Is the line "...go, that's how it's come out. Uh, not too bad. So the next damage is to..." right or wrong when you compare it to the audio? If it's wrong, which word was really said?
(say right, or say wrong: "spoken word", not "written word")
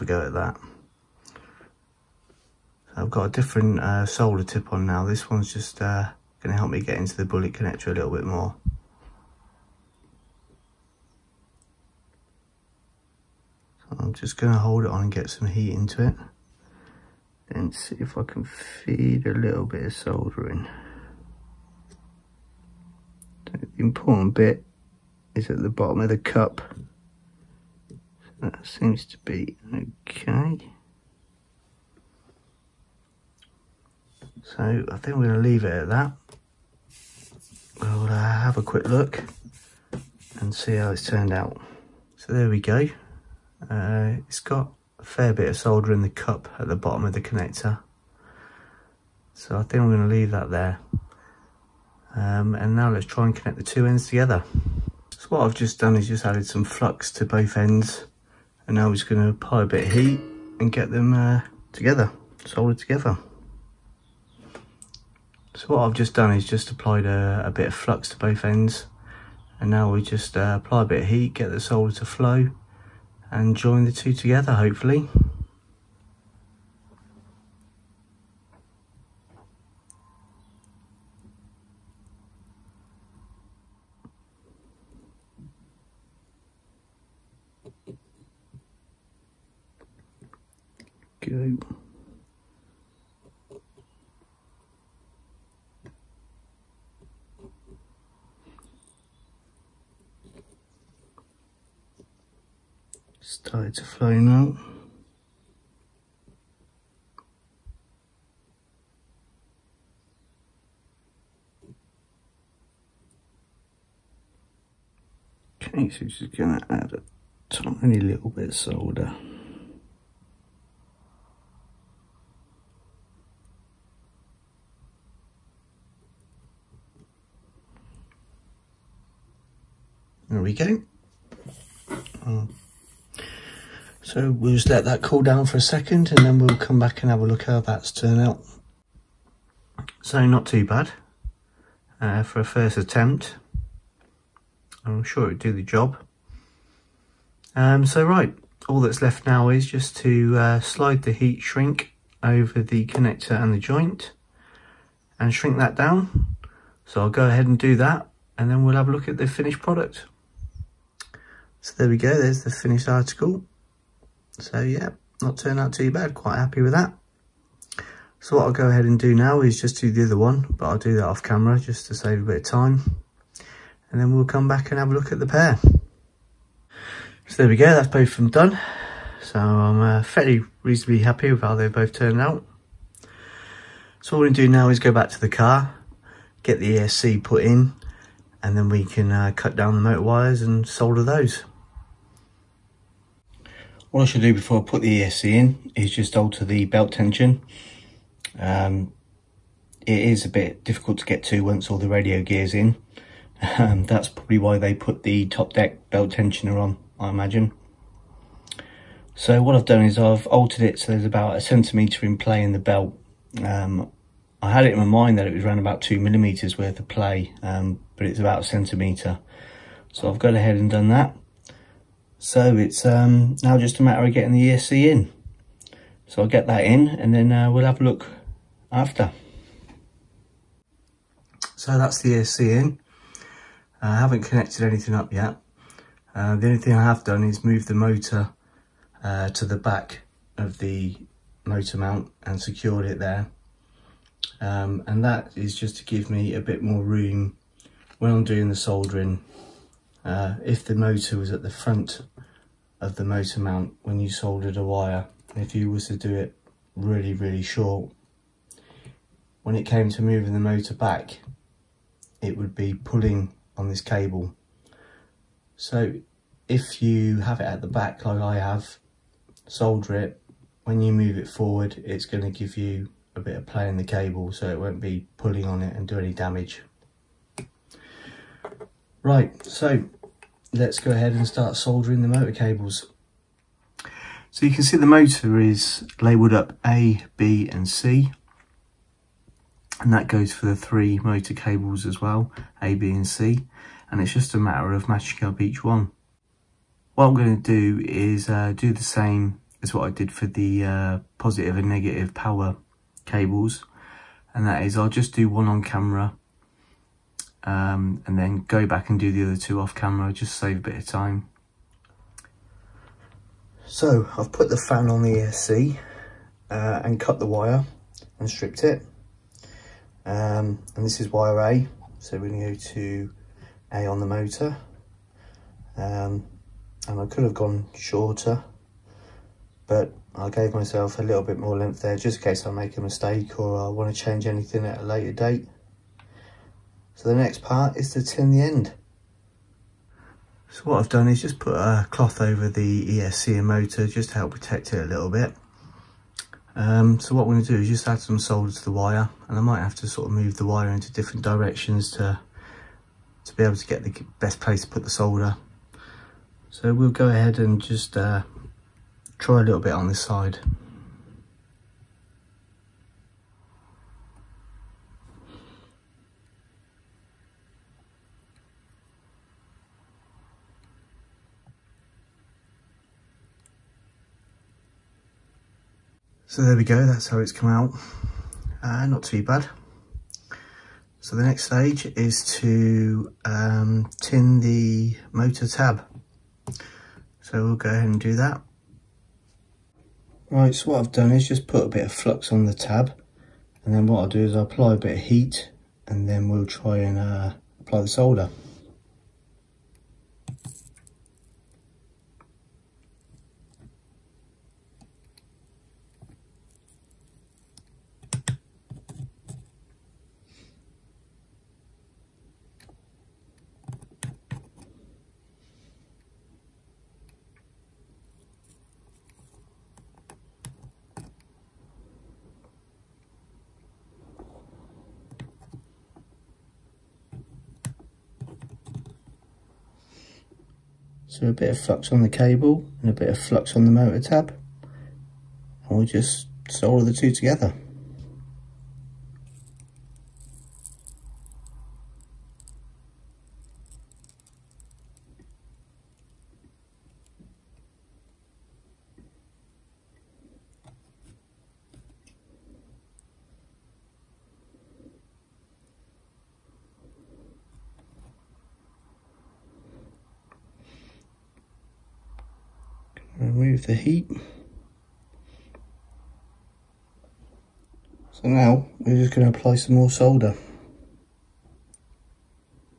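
wrong: "stage", not "damage".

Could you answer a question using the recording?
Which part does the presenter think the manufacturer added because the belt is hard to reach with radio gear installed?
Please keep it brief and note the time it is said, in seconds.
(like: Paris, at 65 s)
top deck belt tensioner, at 205 s.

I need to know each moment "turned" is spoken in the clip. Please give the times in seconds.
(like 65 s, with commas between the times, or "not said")
41 s, 137 s, 165 s, 181 s.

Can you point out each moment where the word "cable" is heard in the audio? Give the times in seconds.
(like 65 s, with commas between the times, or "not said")
263 s, 273 s, 282 s, 291 s, 303 s, 432 s.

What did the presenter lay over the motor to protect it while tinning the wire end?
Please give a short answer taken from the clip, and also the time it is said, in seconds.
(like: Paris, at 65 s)
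a cloth, at 341 s.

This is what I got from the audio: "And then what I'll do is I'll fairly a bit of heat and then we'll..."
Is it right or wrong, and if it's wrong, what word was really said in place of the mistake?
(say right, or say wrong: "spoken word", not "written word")
wrong: "apply", not "fairly".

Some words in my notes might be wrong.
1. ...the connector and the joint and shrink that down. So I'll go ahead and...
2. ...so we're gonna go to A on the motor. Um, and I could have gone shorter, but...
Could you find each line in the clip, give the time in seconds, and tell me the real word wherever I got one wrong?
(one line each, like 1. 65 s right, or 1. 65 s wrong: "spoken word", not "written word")
1. 152 s right
2. 321 s right.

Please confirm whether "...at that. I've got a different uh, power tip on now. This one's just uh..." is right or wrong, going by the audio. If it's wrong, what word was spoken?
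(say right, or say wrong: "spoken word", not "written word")
wrong: "solder", not "power".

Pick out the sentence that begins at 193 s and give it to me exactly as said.
What I should do before I put the ESC in is just alter the belt tension.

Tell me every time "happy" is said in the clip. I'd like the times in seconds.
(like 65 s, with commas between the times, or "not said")
166 s, 180 s.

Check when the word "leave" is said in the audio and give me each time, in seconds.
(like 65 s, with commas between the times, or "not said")
35 s, 50 s.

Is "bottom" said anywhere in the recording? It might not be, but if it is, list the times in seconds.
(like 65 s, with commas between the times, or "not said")
25 s, 46 s.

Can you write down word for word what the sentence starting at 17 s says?
Then see if I can feed a little bit of soldering.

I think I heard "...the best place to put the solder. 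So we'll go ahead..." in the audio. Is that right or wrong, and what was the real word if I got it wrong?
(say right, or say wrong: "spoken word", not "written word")
right.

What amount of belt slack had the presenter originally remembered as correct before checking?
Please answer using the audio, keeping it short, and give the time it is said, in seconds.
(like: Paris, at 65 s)
2 millimetres, at 215 s.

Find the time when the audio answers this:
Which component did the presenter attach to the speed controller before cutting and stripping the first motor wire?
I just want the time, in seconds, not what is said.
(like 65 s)
314 s.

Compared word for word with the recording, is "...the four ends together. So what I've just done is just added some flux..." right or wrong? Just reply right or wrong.
wrong.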